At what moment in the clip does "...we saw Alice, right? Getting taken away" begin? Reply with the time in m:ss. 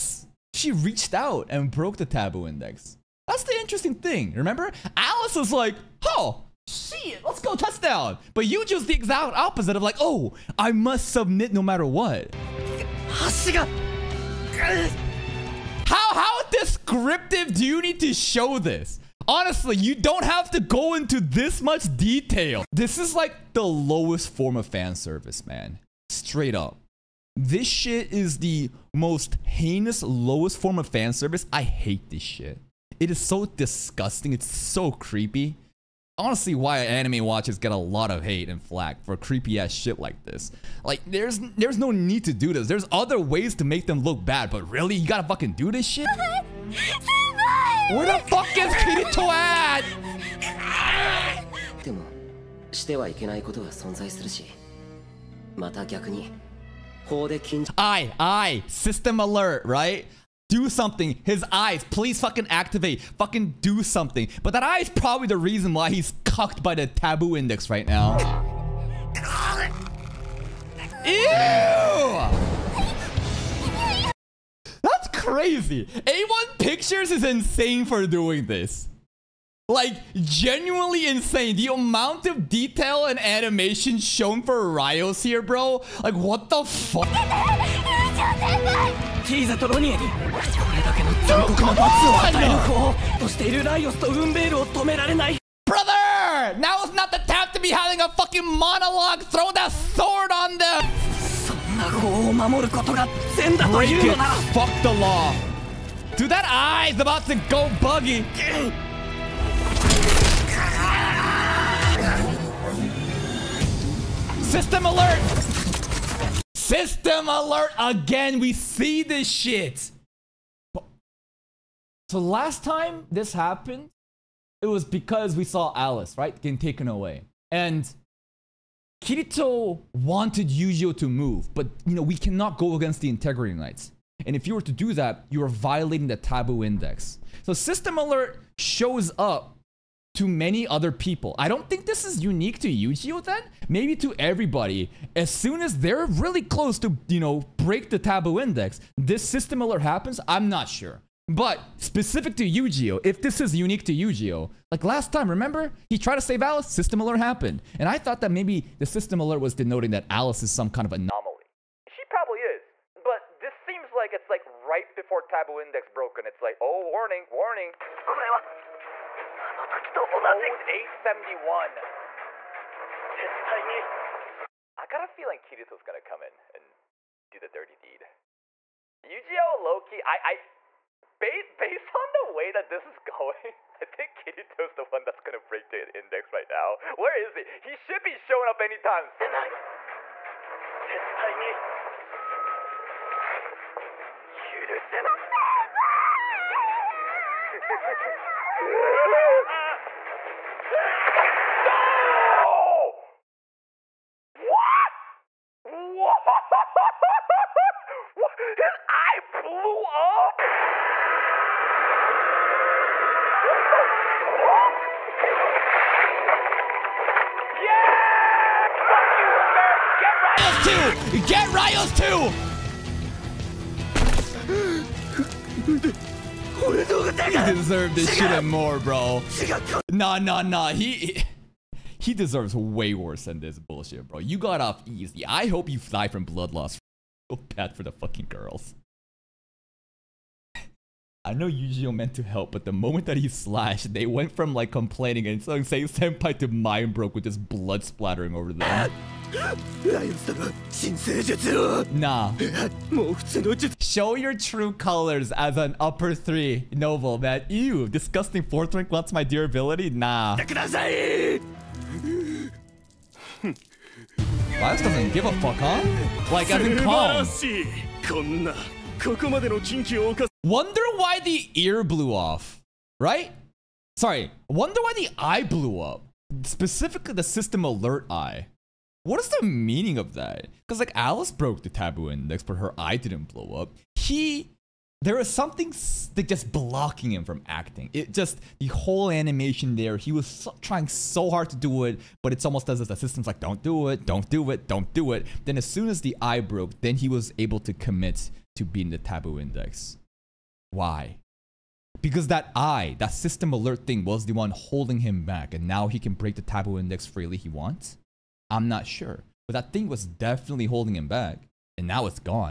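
2:05.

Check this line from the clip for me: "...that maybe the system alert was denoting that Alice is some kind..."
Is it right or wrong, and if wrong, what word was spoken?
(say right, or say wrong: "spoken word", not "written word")
right.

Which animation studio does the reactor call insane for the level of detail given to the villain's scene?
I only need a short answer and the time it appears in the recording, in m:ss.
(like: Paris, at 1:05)
A1 Pictures, at 1:15.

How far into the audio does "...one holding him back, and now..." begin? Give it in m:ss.
5:04.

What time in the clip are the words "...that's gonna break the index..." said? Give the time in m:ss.
3:05.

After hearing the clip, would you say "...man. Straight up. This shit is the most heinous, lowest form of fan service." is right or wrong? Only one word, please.
right.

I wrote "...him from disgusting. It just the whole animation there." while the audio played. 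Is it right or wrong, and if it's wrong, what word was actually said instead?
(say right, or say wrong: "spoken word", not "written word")
wrong: "acting", not "disgusting".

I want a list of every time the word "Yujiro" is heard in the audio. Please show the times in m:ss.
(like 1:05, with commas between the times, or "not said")
2:10, 4:01.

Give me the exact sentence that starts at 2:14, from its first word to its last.
And if you were to do that, you are violating the taboo index.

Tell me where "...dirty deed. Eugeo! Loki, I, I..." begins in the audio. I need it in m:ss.
2:57.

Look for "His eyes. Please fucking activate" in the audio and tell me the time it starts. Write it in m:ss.
1:01.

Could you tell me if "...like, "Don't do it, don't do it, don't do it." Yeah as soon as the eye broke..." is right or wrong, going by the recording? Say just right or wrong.
wrong.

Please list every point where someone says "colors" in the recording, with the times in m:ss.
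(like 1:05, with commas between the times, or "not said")
4:14.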